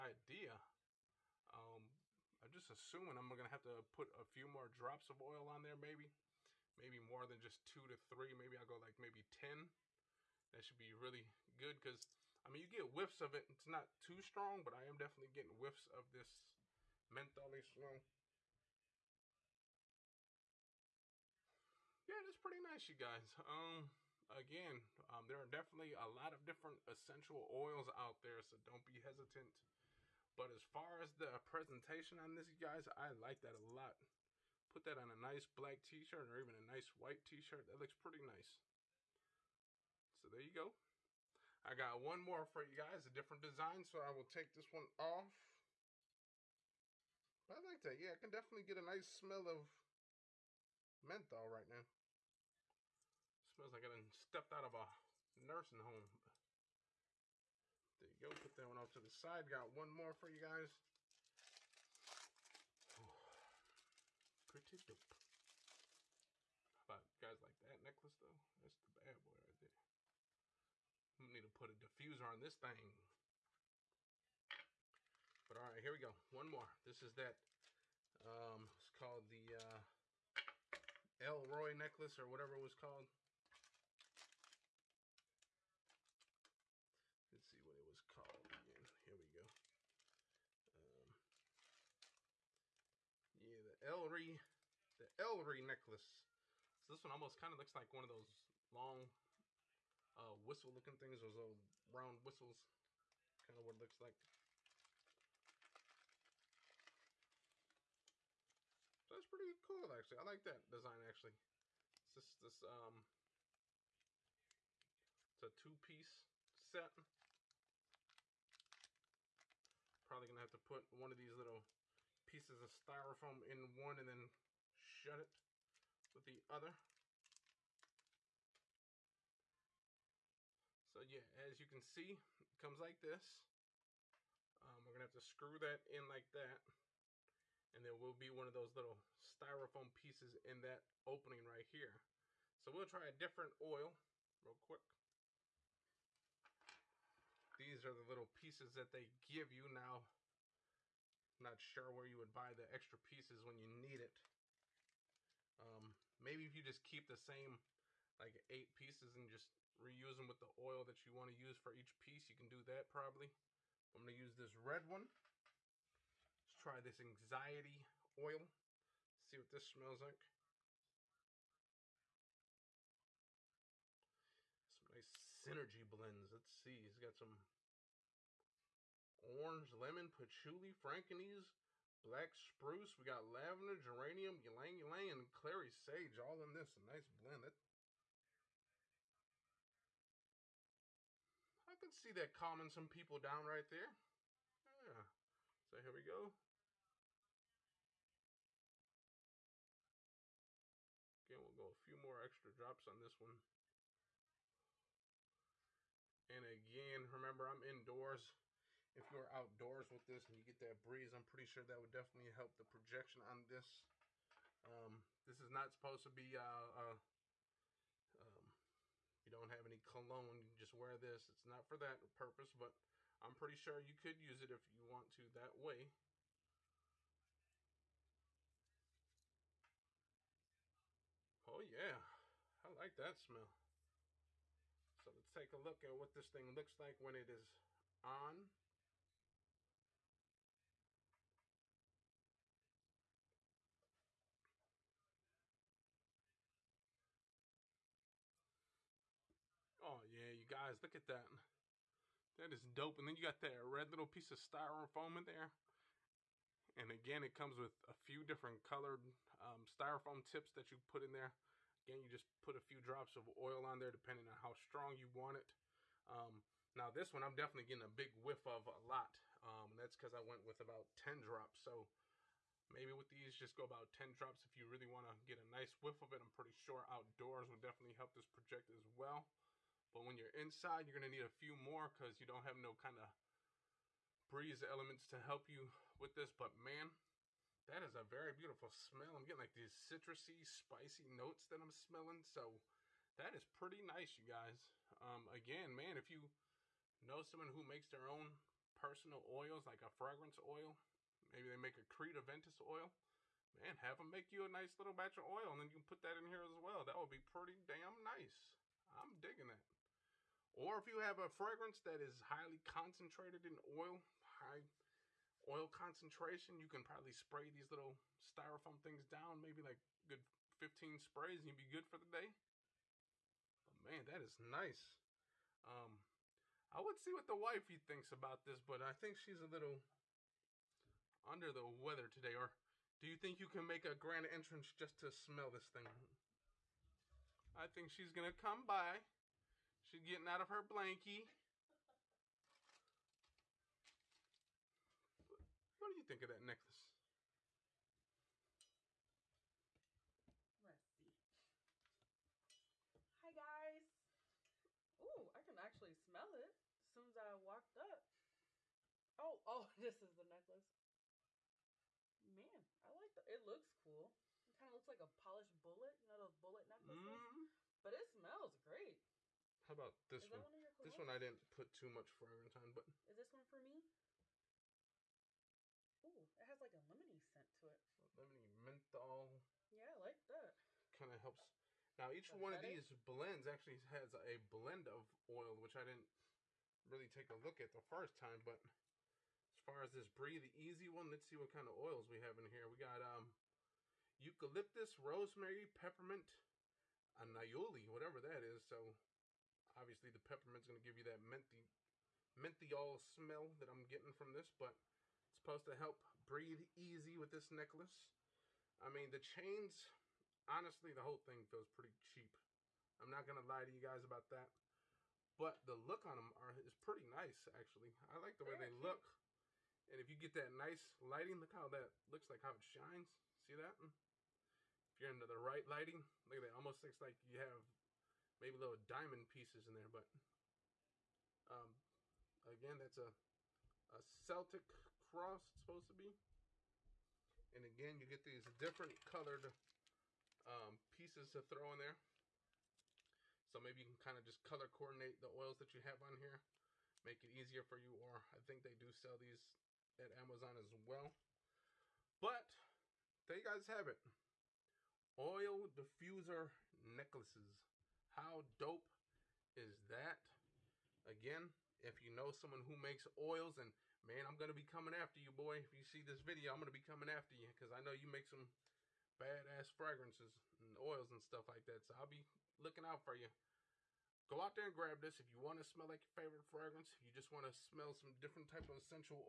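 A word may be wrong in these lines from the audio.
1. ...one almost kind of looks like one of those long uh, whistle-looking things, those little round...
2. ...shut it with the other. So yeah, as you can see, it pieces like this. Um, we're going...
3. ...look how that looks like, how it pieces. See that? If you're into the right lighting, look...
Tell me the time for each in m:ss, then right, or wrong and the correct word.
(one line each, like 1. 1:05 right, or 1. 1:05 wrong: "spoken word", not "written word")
1. 1:37 right
2. 2:04 wrong: "comes", not "pieces"
3. 7:01 wrong: "shines", not "pieces".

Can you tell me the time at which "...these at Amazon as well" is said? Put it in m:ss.
7:29.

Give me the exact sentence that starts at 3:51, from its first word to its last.
Oh yeah, I like that smell.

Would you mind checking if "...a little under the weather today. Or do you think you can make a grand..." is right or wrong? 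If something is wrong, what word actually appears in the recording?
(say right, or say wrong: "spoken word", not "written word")
right.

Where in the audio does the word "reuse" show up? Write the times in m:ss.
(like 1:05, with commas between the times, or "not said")
2:39.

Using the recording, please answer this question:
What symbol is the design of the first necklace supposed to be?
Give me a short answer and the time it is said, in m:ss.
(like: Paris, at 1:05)
Celtic cross, at 7:14.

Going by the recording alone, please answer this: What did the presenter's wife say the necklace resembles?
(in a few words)
polished bullet.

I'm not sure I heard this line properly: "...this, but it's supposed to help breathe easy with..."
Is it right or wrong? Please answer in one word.
right.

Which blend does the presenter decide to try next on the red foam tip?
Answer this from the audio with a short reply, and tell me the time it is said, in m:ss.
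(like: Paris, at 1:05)
anxiety oil, at 2:47.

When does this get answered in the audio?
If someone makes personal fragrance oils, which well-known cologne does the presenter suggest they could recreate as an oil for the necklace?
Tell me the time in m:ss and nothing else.
5:01.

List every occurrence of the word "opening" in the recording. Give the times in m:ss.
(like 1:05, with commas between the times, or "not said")
2:21.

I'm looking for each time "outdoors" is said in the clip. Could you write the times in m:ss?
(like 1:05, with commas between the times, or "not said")
3:29, 4:36.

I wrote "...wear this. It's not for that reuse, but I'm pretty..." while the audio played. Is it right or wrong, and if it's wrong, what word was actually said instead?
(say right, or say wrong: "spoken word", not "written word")
wrong: "purpose", not "reuse".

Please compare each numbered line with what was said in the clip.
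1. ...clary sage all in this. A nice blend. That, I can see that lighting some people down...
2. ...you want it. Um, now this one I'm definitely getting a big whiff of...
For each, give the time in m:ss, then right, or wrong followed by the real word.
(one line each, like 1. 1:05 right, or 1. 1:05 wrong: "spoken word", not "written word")
1. 3:05 wrong: "calming", not "lighting"
2. 4:24 right.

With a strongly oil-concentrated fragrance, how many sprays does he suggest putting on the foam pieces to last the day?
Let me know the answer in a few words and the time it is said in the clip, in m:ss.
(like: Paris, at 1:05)
15, at 5:20.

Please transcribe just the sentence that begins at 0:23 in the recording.
Um, again, um, there are definitely a lot of different essential oils out there, so don't be hesitant.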